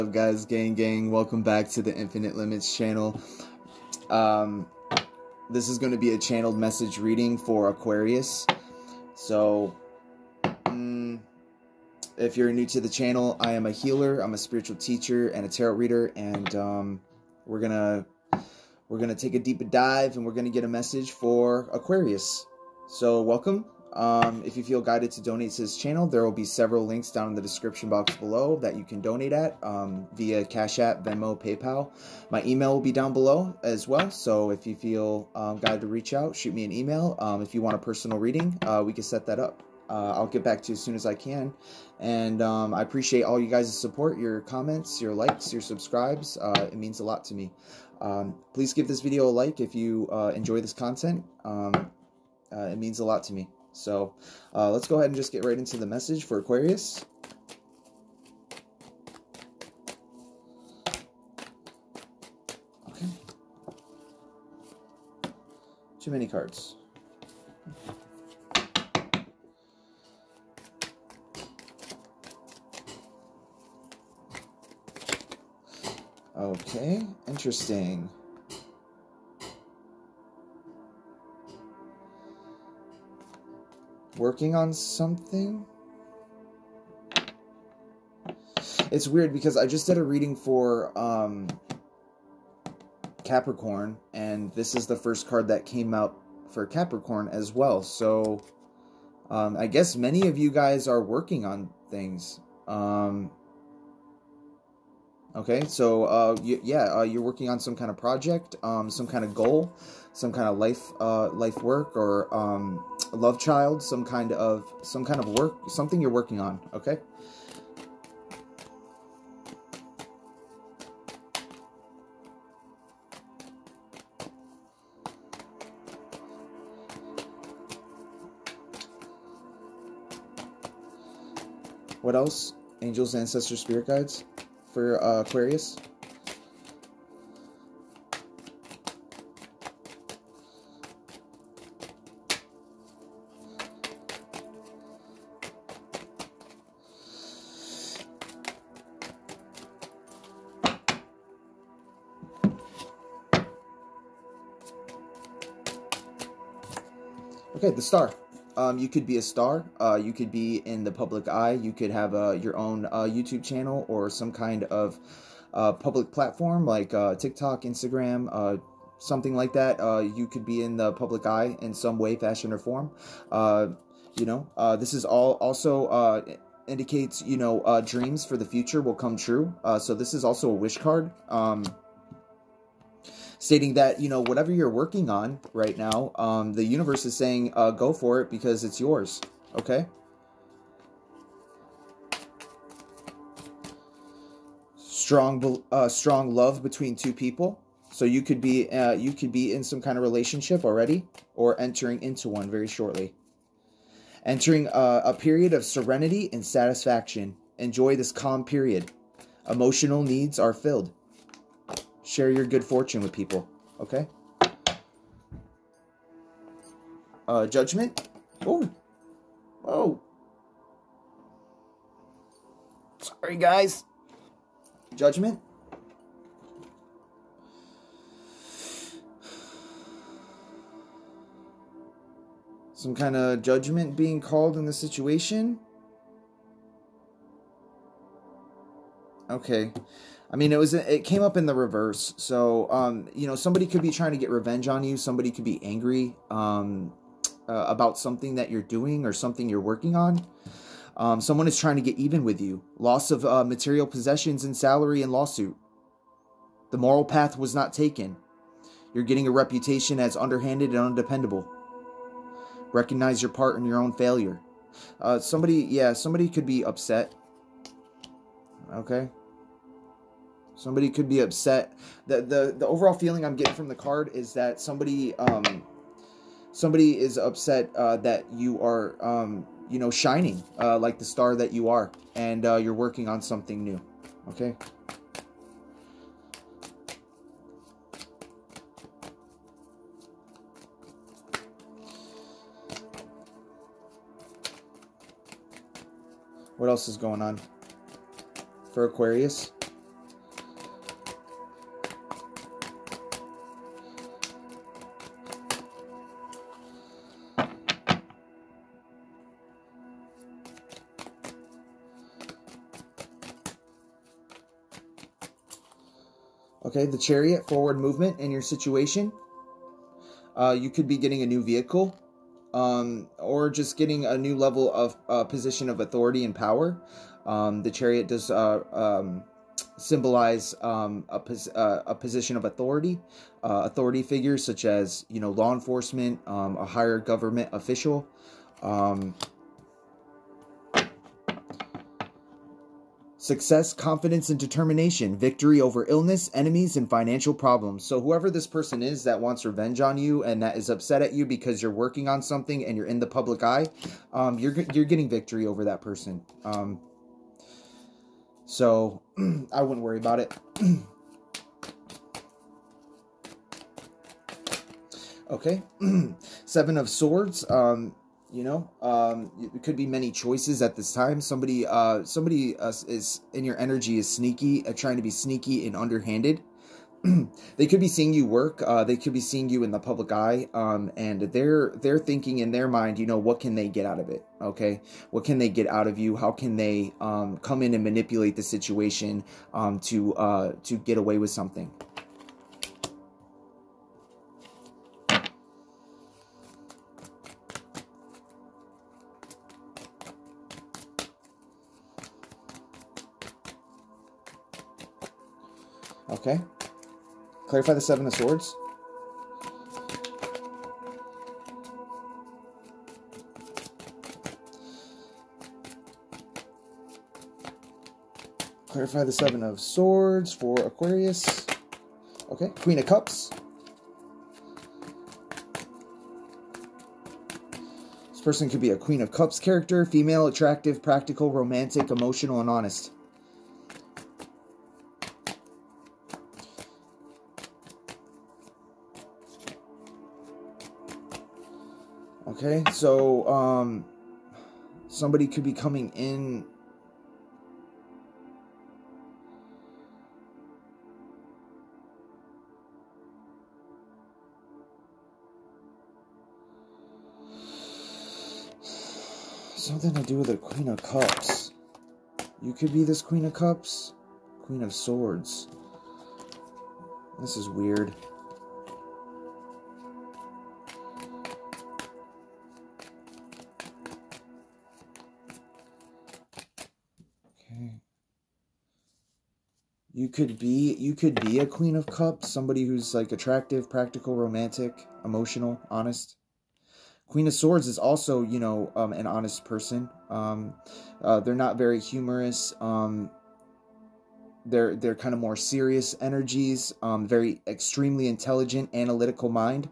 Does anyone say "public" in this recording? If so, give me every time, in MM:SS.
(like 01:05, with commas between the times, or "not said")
02:40, 02:45, 02:50, 05:53, 06:19.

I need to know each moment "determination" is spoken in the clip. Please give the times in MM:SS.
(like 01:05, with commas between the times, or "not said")
05:44.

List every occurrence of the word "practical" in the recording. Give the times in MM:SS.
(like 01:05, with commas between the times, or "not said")
07:10, 08:03.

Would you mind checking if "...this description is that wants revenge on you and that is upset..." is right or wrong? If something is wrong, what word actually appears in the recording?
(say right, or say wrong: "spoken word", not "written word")
wrong: "person", not "description".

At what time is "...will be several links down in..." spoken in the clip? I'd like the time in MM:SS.
00:26.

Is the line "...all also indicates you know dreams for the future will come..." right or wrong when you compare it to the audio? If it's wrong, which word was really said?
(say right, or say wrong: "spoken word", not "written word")
right.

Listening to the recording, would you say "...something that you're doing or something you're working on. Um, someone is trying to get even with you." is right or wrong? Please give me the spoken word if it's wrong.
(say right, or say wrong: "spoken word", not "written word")
right.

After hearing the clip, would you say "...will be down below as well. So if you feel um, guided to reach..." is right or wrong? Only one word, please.
right.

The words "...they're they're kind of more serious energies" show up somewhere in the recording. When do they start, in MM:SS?
08:14.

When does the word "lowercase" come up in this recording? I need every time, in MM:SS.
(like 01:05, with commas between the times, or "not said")
not said.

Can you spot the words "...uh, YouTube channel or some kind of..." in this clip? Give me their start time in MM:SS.
02:42.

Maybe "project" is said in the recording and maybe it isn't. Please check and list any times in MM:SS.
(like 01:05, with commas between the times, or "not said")
01:47.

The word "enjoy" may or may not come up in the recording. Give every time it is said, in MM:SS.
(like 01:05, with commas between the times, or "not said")
00:50, 03:27.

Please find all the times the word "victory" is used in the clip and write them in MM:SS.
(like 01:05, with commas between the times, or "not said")
05:45, 05:55.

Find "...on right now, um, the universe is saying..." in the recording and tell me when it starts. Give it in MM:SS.
03:05.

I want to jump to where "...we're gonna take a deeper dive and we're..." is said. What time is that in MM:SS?
00:18.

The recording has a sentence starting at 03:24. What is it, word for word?
Entering a, uh, a period of serenity and satisfaction.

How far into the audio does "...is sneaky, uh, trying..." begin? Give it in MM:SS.
06:13.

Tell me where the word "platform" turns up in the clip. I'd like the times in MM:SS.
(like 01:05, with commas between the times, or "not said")
02:46.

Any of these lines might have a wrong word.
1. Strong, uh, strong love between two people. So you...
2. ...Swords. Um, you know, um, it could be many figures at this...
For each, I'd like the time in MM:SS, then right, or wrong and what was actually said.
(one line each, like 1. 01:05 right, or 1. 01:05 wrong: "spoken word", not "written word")
1. 03:14 right
2. 06:06 wrong: "choices", not "figures".